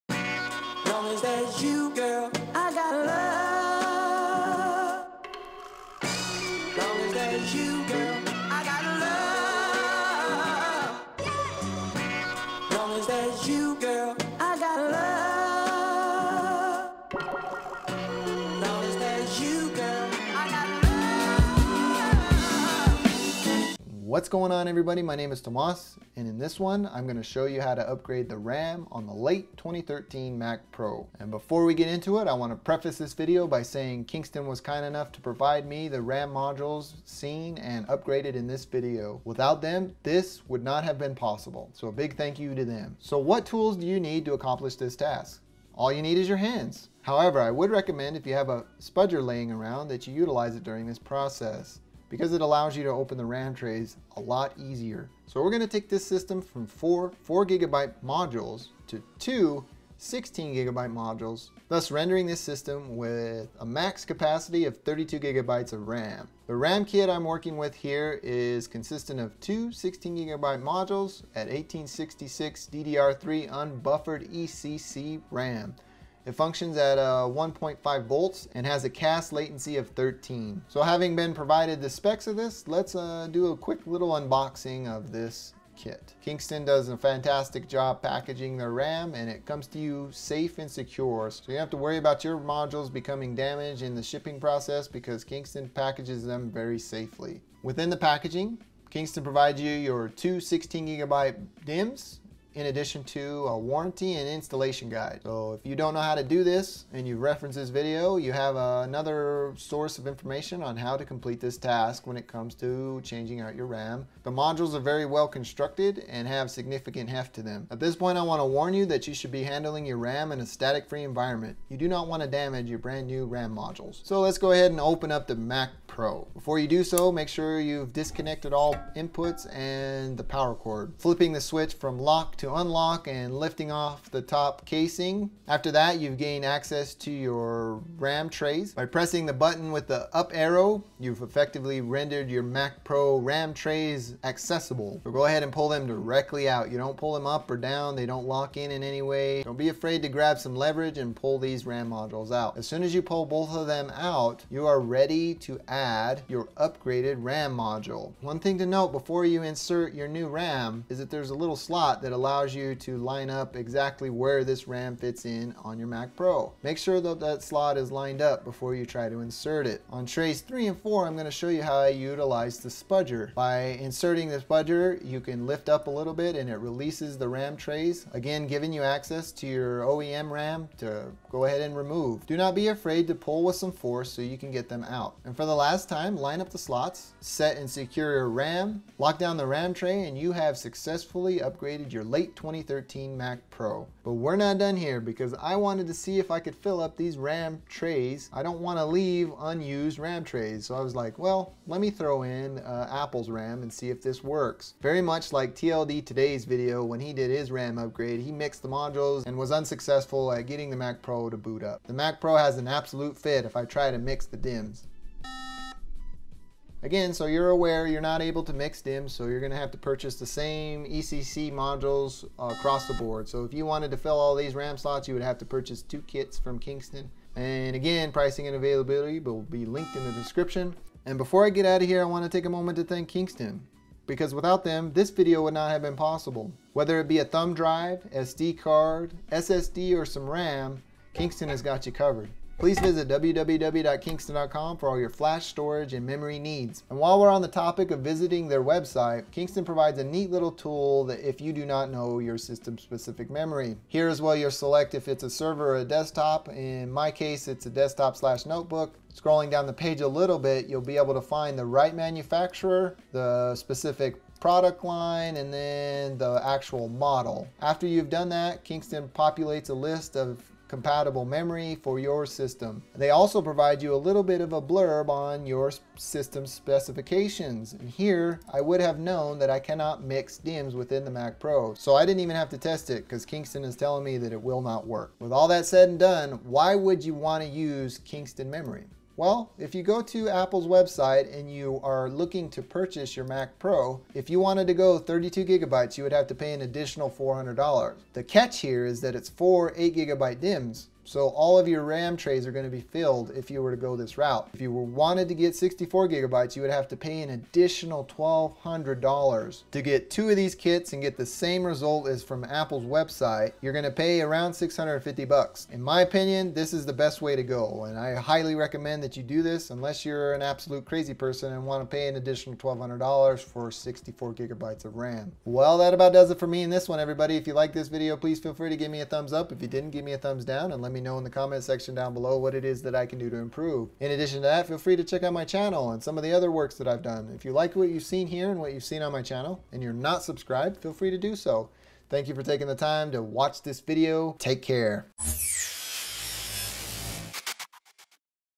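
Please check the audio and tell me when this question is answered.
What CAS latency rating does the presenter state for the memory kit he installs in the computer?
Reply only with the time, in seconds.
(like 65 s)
78 s.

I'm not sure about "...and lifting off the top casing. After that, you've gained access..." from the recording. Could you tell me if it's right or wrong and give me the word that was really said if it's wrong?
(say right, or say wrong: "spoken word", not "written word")
right.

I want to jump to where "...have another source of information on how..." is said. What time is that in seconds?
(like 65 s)
108 s.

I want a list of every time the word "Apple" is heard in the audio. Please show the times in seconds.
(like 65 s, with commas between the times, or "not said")
202 s, 290 s, 312 s.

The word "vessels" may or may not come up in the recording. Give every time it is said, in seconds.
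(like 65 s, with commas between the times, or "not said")
not said.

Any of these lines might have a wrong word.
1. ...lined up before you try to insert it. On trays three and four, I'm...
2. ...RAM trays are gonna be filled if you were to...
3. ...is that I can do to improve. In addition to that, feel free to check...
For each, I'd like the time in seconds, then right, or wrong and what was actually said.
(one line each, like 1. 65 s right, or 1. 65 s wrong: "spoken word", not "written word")
1. 167 s right
2. 301 s right
3. 332 s right.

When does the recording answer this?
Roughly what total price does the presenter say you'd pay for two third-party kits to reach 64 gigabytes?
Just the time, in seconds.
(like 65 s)
314 s.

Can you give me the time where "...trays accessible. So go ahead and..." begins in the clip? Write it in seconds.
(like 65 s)
143 s.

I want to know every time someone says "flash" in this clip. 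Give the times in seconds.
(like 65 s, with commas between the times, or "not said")
245 s.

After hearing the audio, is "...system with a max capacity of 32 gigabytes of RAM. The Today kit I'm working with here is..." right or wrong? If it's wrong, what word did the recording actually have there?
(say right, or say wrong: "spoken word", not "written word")
wrong: "RAM", not "Today".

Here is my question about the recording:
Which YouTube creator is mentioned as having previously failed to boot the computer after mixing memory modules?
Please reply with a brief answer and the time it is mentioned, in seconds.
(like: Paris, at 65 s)
TLD Today, at 205 s.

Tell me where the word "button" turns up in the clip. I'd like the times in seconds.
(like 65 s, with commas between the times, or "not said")
139 s.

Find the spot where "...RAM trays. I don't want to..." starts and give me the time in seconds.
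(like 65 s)
197 s.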